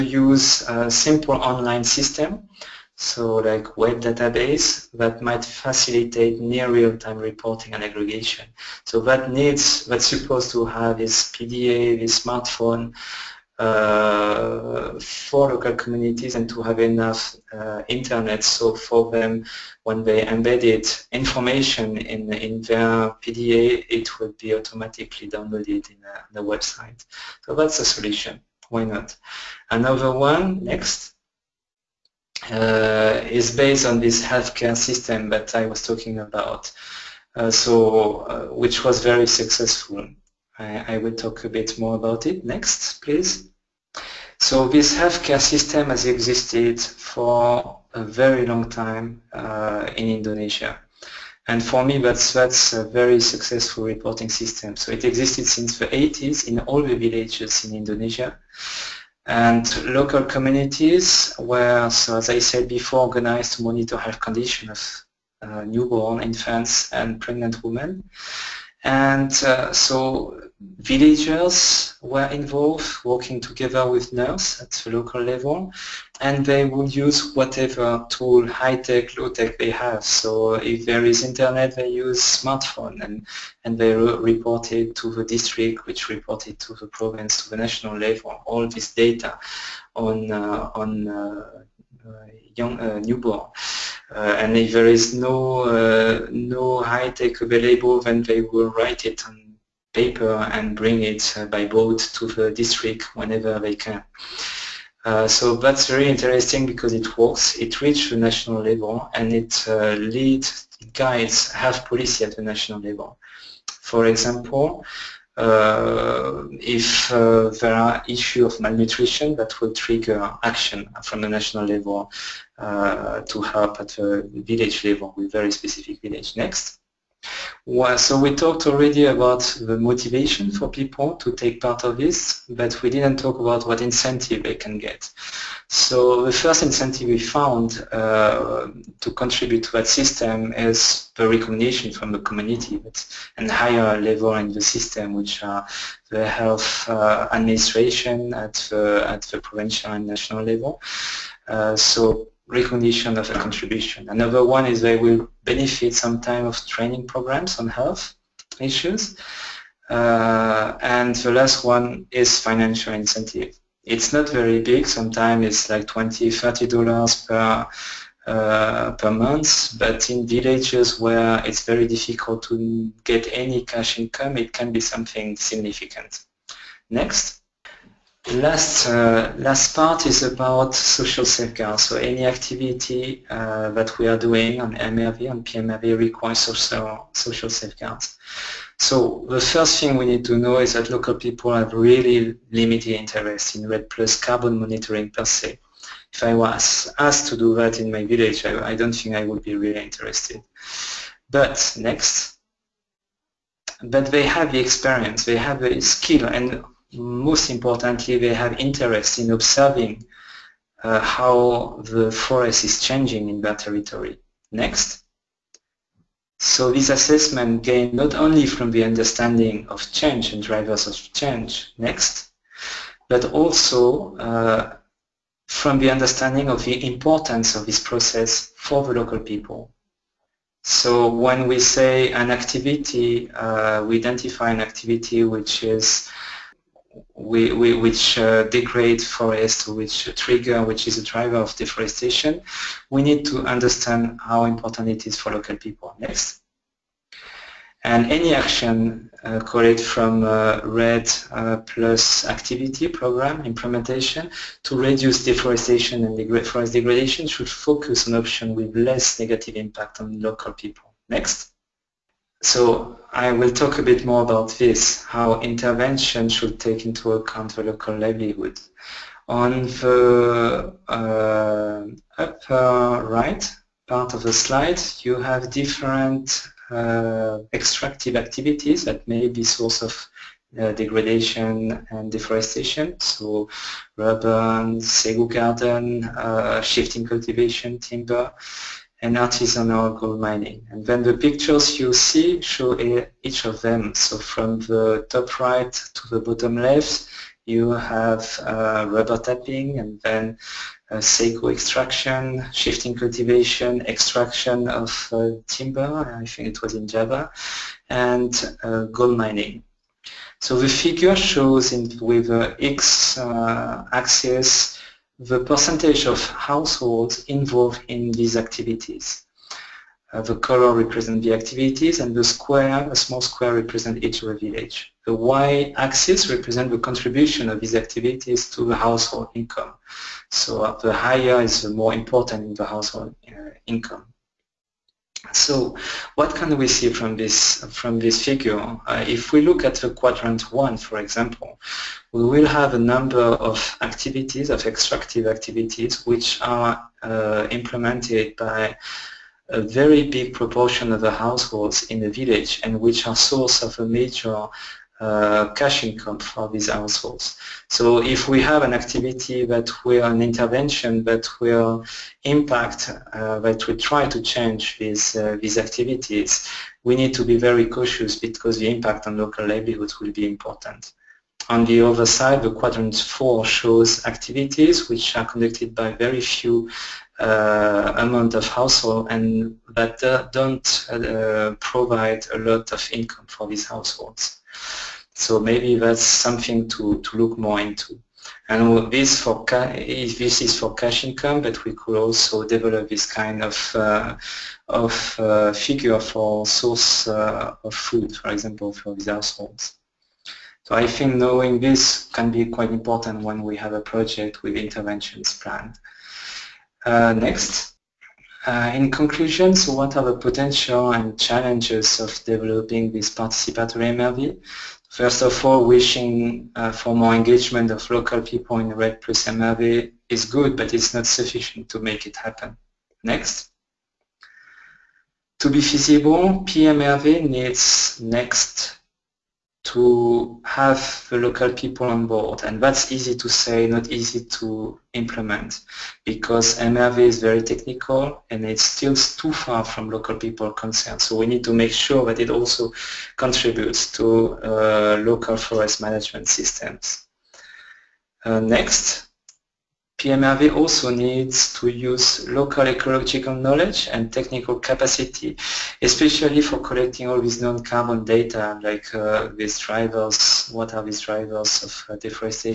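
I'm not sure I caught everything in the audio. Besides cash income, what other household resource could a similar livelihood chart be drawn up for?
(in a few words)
Food.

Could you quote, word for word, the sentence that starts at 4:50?
And then the pictures you see show each of them.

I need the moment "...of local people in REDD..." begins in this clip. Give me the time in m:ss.
6:57.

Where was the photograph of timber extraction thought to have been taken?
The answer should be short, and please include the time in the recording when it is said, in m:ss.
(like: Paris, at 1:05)
Java, at 5:06.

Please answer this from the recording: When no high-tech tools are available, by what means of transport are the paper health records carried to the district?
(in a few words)
Boat.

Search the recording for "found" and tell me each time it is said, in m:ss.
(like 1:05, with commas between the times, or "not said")
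2:17.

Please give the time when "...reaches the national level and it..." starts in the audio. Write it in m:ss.
1:47.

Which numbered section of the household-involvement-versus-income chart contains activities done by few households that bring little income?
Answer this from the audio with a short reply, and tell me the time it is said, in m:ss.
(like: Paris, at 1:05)
Quadrant 4, at 6:12.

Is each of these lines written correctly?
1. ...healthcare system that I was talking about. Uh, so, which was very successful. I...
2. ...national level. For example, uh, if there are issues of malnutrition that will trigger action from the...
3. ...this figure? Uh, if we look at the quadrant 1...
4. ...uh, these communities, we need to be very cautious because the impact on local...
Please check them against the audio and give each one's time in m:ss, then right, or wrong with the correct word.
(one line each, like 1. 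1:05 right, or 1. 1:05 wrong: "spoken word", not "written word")
1. 0:34 right
2. 1:52 right
3. 5:37 right
4. 6:05 wrong: "activities", not "communities".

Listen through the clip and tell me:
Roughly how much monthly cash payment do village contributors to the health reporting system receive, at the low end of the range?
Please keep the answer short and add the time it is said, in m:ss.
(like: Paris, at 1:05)
$20, at 2:45.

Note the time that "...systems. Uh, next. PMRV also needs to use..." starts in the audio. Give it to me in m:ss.
7:26.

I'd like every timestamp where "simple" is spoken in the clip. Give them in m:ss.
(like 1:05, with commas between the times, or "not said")
0:00.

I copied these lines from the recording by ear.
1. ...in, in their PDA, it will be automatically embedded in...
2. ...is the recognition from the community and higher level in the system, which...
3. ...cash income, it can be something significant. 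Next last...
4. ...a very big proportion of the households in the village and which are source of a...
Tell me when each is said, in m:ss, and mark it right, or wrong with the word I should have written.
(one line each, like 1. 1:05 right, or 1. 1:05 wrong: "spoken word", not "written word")
1. 0:21 wrong: "downloaded", not "embedded"
2. 2:20 right
3. 2:53 right
4. 5:49 right.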